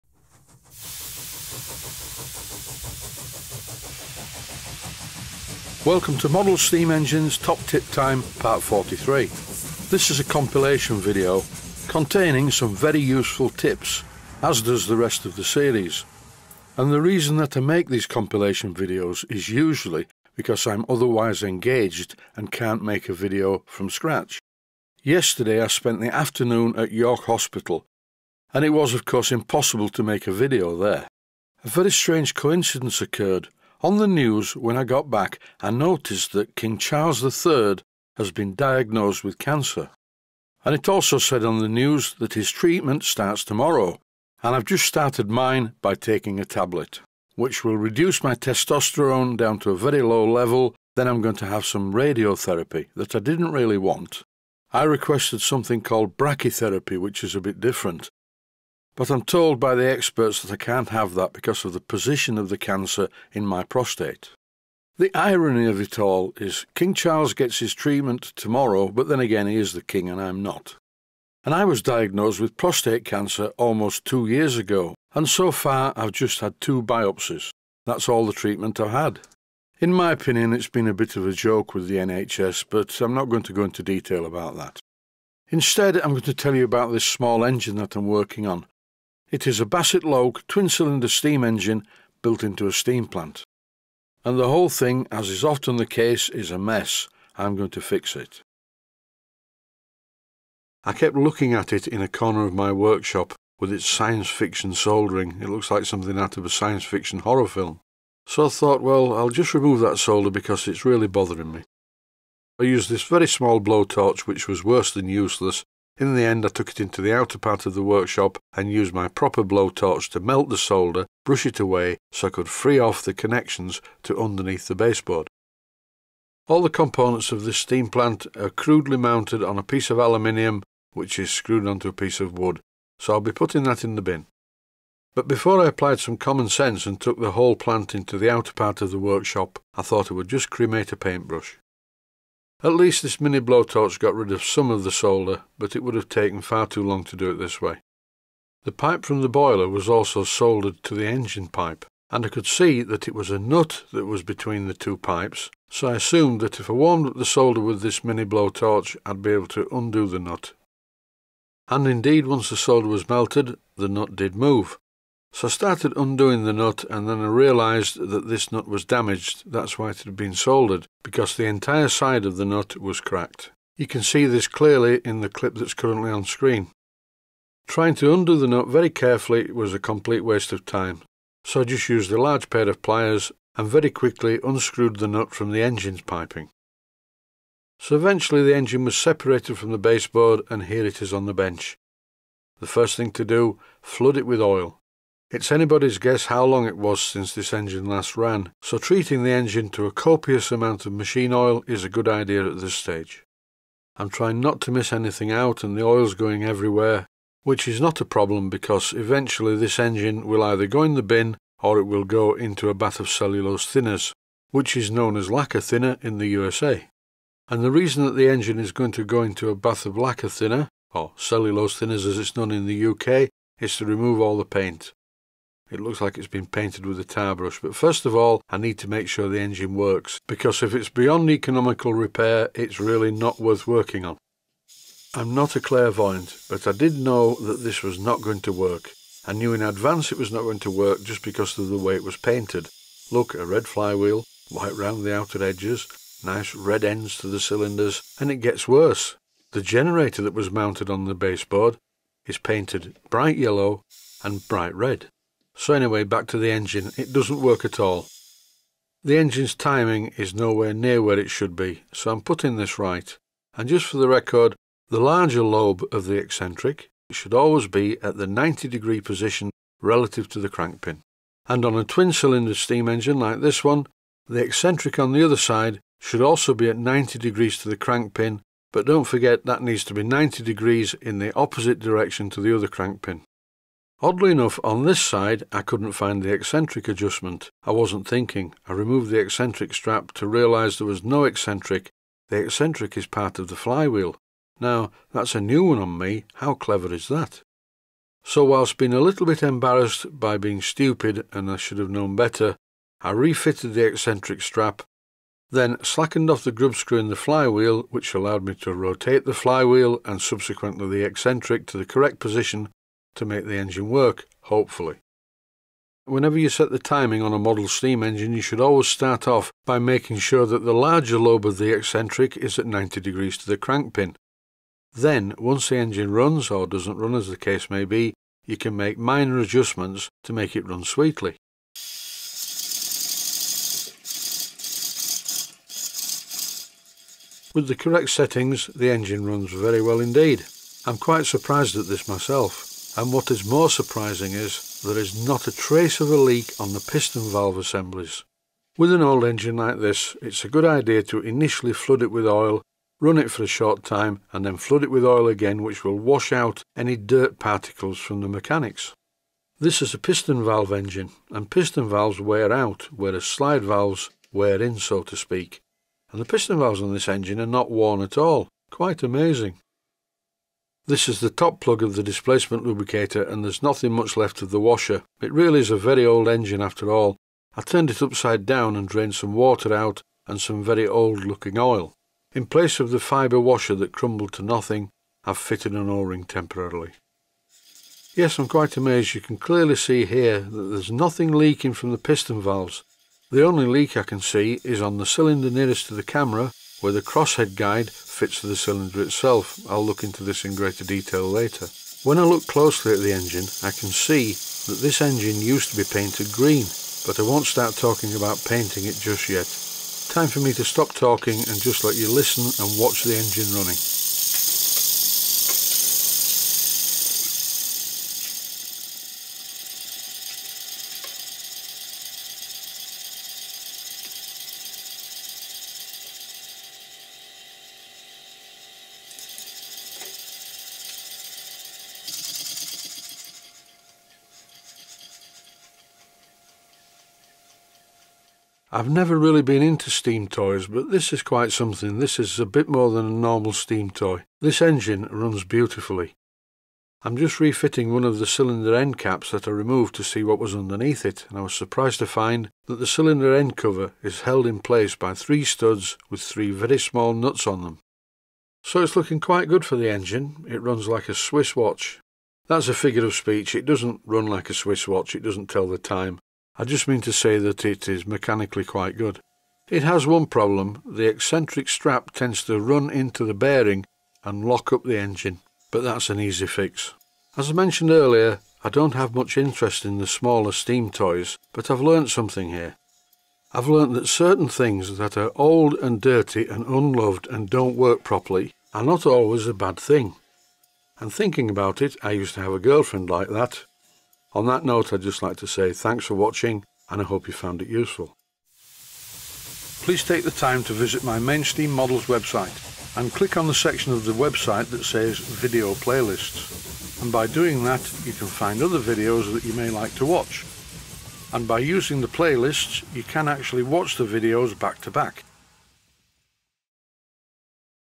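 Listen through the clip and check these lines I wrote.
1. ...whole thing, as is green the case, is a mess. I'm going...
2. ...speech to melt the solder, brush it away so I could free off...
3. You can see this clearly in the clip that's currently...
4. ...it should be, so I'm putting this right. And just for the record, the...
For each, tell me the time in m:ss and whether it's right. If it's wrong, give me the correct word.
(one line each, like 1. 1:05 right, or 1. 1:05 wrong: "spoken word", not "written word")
1. 1:34 wrong: "often", not "green"
2. 1:59 wrong: "blowtorch", not "speech"
3. 2:53 right
4. 4:21 right.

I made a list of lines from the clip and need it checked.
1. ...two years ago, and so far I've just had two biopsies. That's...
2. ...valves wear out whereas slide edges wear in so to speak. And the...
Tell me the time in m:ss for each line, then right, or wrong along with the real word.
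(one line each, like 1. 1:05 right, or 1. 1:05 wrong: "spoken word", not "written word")
1. 1:14 right
2. 6:01 wrong: "valves", not "edges".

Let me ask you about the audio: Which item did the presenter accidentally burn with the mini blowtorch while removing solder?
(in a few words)
A paintbrush.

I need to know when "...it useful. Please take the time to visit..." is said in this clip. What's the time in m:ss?
8:17.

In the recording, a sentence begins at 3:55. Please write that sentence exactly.
I'm not a clairvoyant, but I did know that this was not going to work.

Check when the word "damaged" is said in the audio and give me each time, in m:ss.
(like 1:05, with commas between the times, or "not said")
2:48.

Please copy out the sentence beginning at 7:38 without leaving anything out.
So it's looking quite good for the engine, it runs like a Swiss watch.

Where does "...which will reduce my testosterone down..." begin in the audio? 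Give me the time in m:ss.
0:47.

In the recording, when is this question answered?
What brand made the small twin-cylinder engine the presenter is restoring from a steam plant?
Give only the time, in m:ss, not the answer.
1:29.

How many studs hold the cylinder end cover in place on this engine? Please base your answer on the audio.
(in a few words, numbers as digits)
3.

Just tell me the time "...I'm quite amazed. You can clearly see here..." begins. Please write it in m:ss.
6:28.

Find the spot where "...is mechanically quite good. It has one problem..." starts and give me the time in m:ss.
7:47.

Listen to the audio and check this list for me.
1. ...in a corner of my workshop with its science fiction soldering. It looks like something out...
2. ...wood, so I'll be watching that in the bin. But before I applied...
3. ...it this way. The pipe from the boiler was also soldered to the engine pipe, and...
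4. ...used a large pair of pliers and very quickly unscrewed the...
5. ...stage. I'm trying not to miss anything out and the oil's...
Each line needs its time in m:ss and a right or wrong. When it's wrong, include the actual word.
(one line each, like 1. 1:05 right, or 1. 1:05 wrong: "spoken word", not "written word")
1. 1:41 right
2. 2:12 wrong: "putting", not "watching"
3. 2:27 right
4. 3:01 right
5. 3:22 right.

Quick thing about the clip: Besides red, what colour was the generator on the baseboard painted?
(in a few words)
Yellow.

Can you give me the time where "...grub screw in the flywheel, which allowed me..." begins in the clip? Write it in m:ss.
5:06.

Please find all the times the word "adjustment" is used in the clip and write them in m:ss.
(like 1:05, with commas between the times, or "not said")
4:46, 5:29.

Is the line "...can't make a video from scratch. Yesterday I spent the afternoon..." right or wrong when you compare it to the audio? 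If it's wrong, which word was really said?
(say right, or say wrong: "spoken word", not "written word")
right.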